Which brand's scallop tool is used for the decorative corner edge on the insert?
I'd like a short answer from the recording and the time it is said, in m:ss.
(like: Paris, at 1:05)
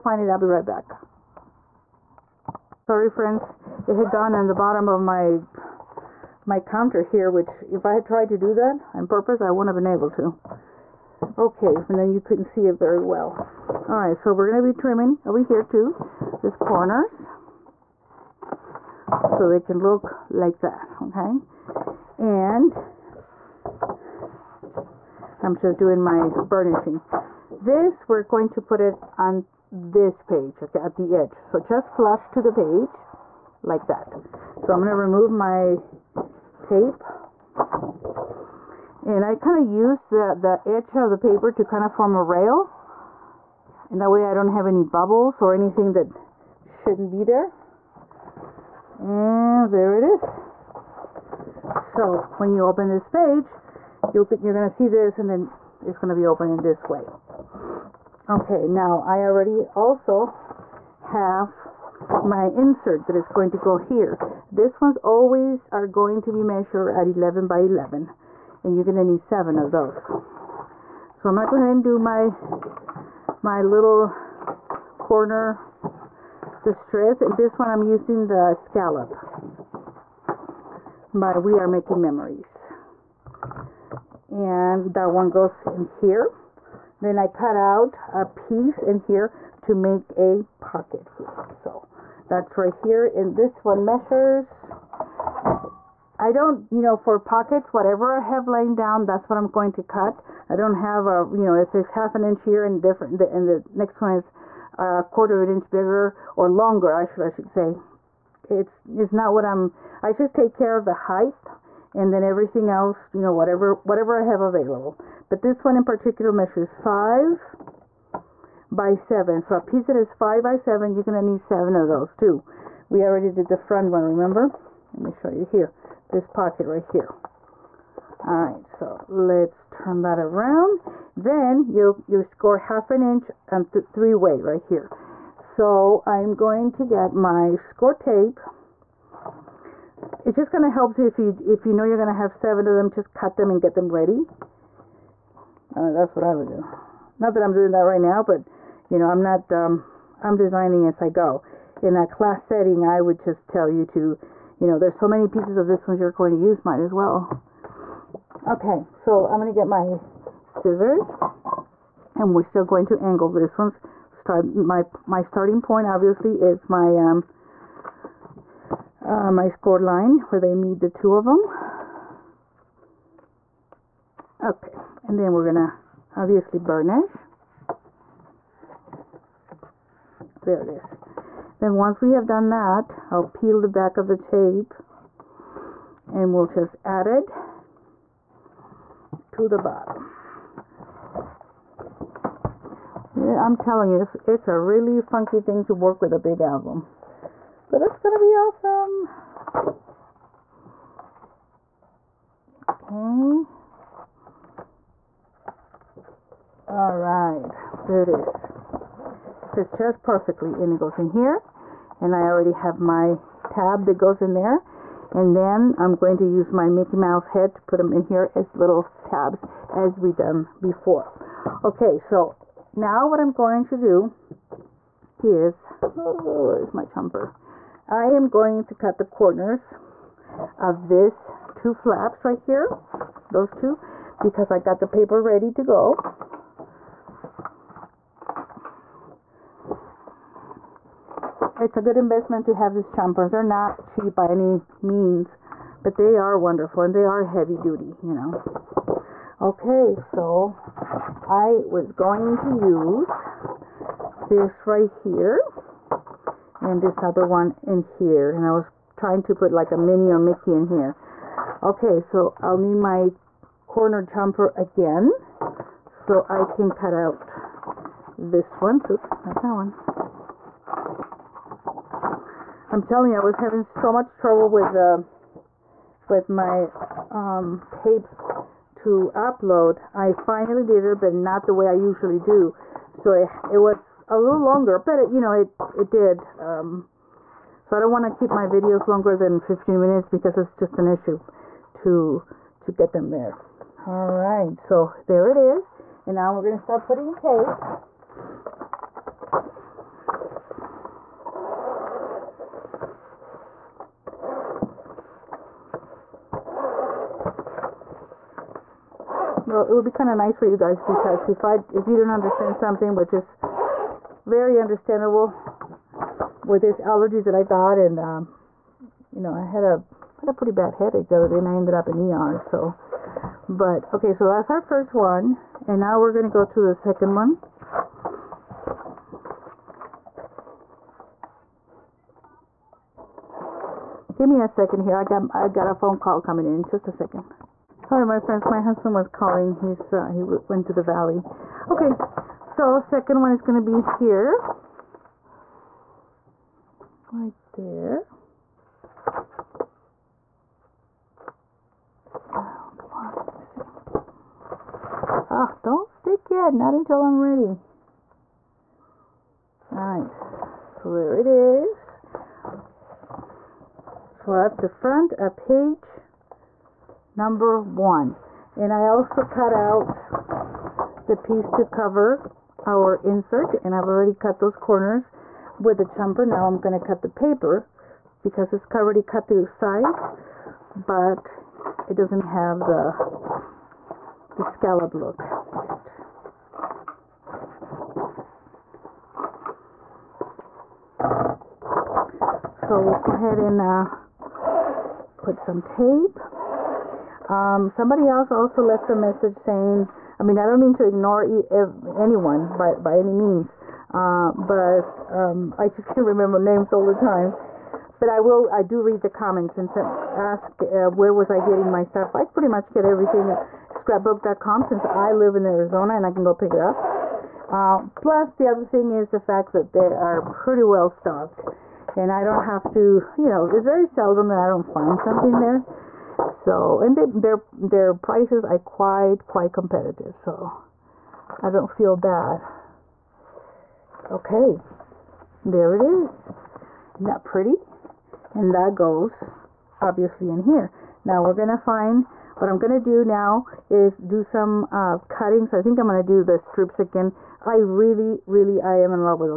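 We Are Making Memories, at 1:21.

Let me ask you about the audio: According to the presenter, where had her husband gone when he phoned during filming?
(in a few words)
the valley.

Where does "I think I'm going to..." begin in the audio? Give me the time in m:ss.
7:25.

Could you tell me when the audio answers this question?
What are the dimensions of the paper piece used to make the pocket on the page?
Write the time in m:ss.
1:56.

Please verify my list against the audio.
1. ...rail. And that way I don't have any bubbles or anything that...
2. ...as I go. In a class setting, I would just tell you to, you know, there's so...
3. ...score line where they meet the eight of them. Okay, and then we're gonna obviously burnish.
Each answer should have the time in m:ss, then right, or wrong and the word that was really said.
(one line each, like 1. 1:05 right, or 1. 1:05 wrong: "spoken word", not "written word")
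1. 0:42 right
2. 2:30 right
3. 2:49 wrong: "two", not "eight".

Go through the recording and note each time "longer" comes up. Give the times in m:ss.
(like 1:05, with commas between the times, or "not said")
1:46, 4:44, 4:48.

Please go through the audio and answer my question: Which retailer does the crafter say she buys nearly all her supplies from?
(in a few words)
scrapbook.com.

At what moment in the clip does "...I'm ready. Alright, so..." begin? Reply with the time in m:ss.
5:57.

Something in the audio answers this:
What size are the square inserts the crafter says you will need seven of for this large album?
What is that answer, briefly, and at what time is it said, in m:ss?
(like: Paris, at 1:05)
11 by 11, at 1:07.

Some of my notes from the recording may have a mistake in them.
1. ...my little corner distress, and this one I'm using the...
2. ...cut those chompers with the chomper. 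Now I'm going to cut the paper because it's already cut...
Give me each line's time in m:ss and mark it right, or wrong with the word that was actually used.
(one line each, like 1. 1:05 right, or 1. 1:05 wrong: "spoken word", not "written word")
1. 1:13 right
2. 6:14 wrong: "corners", not "chompers".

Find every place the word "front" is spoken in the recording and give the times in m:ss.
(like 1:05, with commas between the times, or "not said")
2:03, 6:04.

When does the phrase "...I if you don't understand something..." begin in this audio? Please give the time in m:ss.
5:11.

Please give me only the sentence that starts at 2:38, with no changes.
Okay, so I'm going to get my scissors, and we're still going to angle this one's start.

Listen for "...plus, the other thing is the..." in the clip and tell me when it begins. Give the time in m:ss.
6:57.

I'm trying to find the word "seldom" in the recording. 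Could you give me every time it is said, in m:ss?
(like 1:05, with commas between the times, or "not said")
7:03.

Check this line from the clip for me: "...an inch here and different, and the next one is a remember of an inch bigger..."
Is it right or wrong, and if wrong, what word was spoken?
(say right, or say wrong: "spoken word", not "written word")
wrong: "quarter", not "remember".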